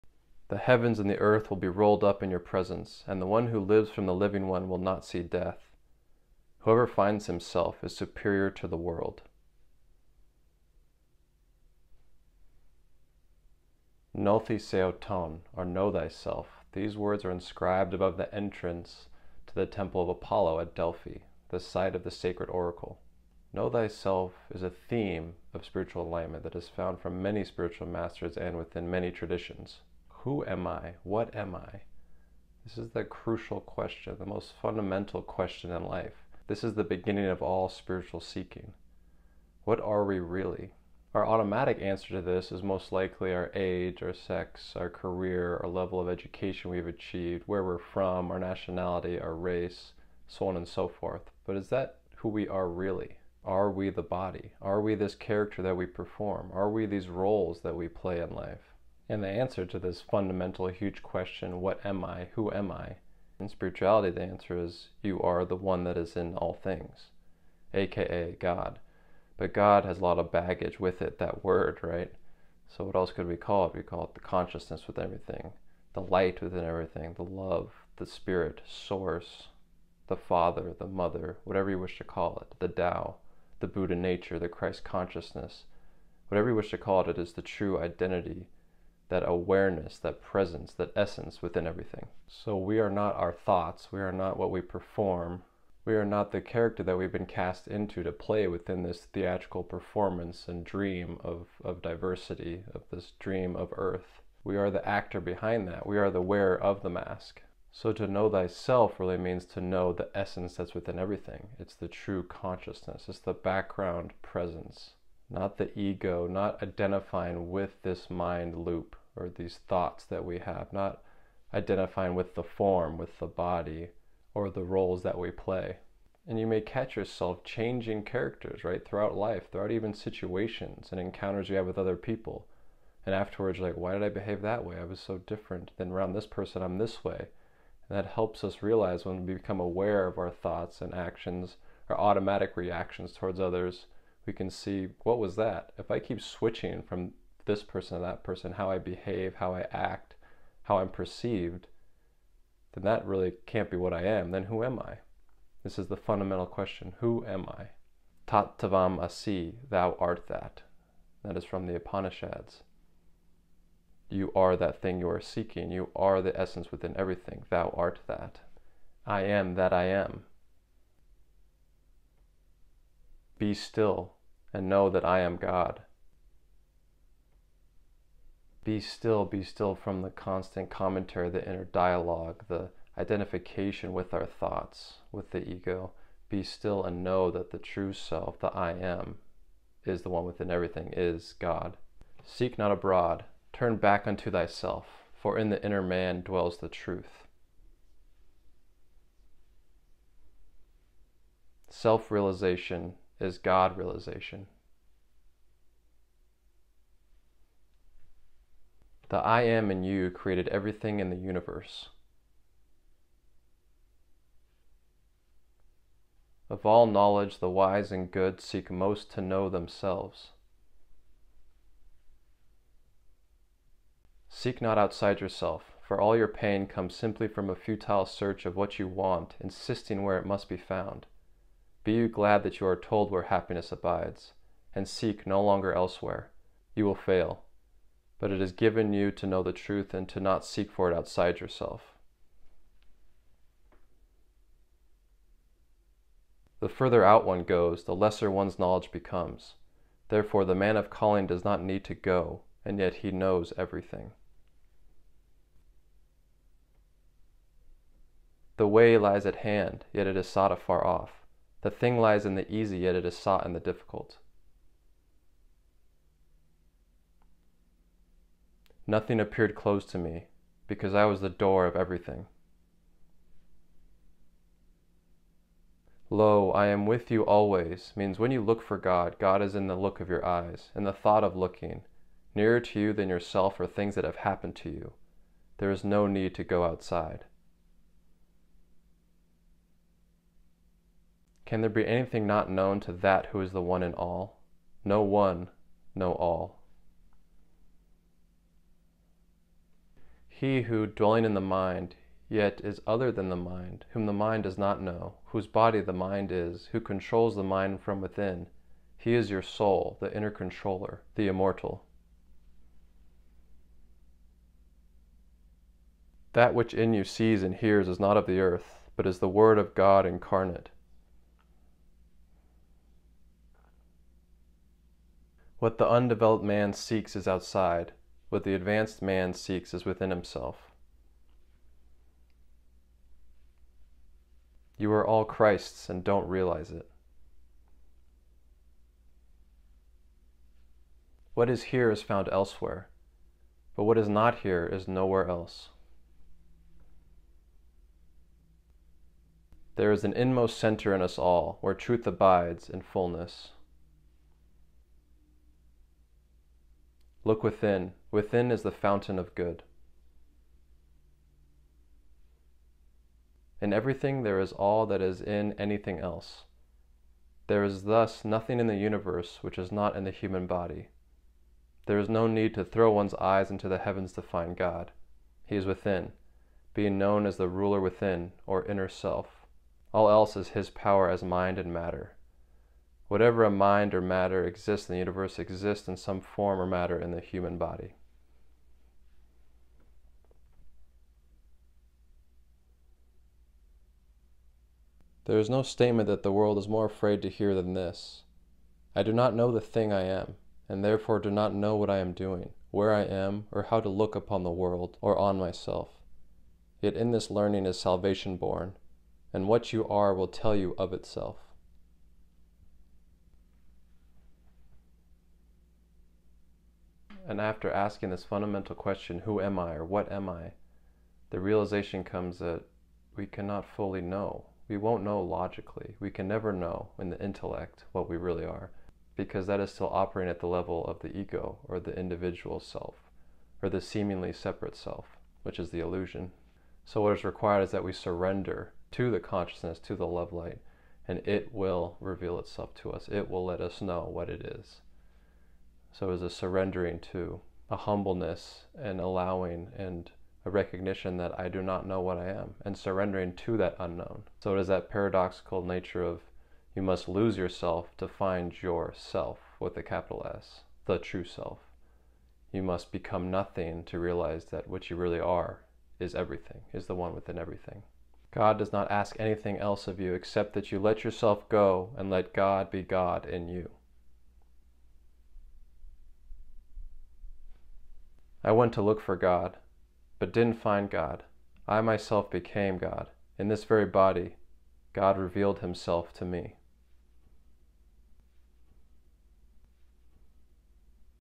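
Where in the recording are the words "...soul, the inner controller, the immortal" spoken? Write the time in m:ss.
5:09.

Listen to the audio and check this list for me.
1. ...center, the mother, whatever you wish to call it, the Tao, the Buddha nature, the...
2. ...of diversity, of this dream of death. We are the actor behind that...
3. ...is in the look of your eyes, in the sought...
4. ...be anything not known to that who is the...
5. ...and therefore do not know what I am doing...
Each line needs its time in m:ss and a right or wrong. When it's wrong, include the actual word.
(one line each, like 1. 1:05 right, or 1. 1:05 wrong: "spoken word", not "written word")
1. 1:20 wrong: "father", not "center"
2. 1:41 wrong: "earth", not "death"
3. 4:39 wrong: "thought", not "sought"
4. 4:51 right
5. 6:40 right.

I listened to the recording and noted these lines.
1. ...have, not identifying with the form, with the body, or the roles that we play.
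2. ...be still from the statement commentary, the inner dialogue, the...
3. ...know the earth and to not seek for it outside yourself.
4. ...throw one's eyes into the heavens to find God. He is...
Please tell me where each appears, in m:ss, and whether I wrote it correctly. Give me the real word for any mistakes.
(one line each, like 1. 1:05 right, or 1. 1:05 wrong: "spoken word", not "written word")
1. 2:00 right
2. 2:59 wrong: "constant", not "statement"
3. 3:59 wrong: "truth", not "earth"
4. 6:12 right.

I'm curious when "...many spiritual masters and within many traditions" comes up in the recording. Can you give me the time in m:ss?
0:27.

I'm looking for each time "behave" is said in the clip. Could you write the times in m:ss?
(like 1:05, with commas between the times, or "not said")
2:14, 2:28.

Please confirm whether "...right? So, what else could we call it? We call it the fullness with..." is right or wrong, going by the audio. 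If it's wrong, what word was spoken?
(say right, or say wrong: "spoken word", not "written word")
wrong: "consciousness", not "fullness".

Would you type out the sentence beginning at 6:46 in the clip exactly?
Yet in this learning is salvation born, and what you are will tell you of itself.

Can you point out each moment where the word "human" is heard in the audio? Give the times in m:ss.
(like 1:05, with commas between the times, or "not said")
6:10, 6:27.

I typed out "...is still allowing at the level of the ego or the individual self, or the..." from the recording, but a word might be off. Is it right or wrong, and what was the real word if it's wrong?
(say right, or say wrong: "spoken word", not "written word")
wrong: "operating", not "allowing".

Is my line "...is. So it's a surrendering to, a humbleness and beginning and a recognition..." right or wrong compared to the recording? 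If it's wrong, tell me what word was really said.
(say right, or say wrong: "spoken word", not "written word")
wrong: "allowing", not "beginning".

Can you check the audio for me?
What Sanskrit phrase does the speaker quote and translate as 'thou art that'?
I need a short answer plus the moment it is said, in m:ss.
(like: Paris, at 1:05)
Tat tavam asi, at 2:38.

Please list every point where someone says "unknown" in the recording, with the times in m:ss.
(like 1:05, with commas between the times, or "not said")
7:33.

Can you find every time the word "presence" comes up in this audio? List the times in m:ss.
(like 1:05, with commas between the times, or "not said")
0:02, 1:30, 1:54.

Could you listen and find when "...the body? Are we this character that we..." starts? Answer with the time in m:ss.
0:53.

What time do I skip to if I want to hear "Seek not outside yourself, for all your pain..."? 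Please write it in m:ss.
3:44.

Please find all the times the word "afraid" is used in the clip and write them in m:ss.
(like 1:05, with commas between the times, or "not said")
6:36.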